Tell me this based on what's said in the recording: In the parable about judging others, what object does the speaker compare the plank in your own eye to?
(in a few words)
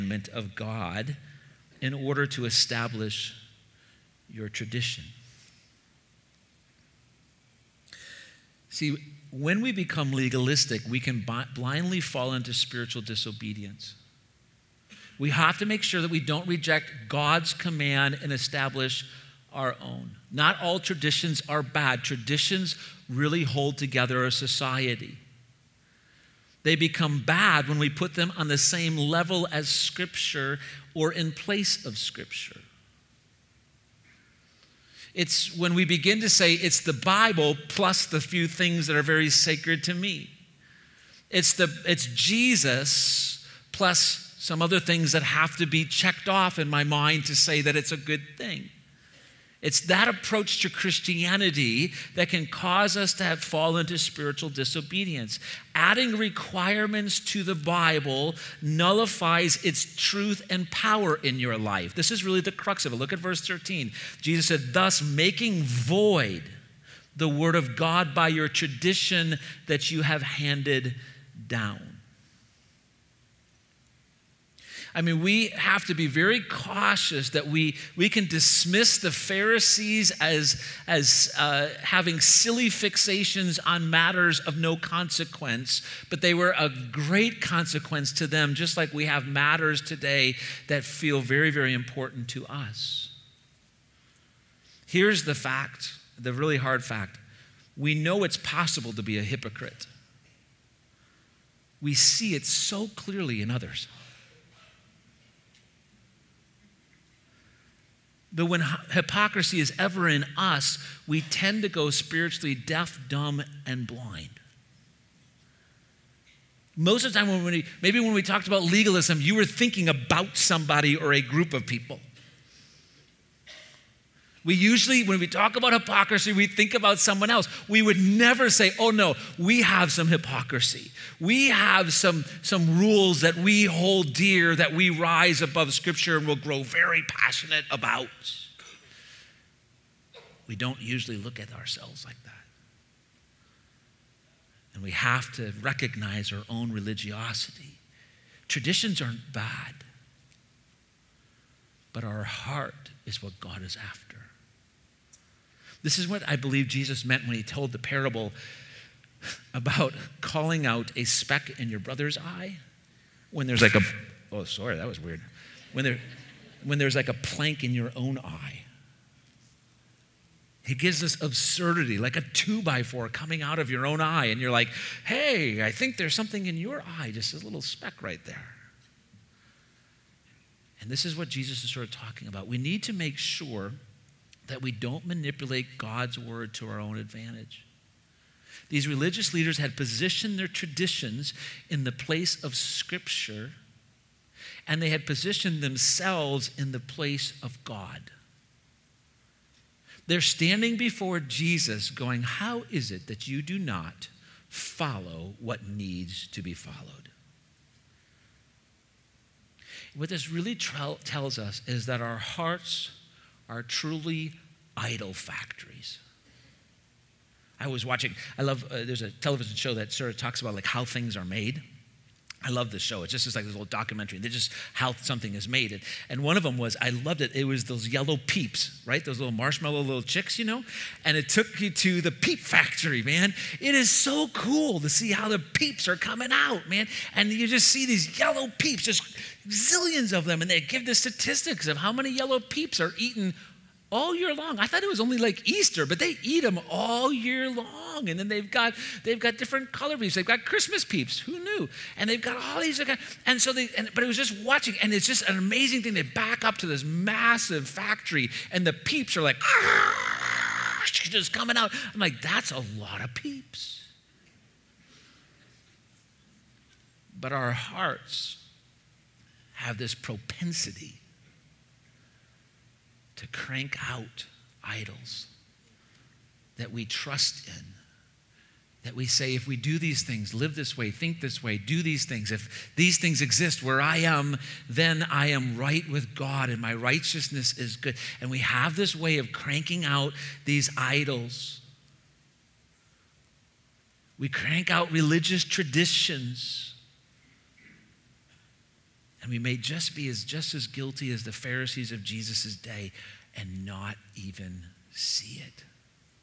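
A two by four.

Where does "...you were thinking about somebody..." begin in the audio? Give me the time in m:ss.
1:59.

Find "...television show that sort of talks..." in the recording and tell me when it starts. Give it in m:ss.
3:39.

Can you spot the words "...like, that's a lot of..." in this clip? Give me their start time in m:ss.
4:22.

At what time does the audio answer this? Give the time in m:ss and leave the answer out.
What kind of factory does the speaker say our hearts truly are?
3:34.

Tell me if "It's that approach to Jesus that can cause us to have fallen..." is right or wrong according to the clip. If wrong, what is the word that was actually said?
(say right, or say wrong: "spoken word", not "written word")
wrong: "Christianity", not "Jesus".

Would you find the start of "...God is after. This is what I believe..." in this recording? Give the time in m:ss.
2:33.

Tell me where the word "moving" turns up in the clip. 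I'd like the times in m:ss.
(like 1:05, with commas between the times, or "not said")
not said.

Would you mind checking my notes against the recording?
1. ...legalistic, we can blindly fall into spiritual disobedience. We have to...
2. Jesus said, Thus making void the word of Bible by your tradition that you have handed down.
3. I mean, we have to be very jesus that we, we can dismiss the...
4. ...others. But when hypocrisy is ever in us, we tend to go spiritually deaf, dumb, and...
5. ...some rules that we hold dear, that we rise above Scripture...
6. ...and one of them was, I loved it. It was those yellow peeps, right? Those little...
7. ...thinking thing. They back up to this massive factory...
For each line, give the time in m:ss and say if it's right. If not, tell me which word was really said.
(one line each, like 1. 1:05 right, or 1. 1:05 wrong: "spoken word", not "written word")
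1. 0:10 right
2. 1:04 wrong: "God", not "Bible"
3. 1:14 wrong: "cautious", not "jesus"
4. 1:43 right
5. 2:12 right
6. 3:46 right
7. 4:15 wrong: "amazing", not "thinking".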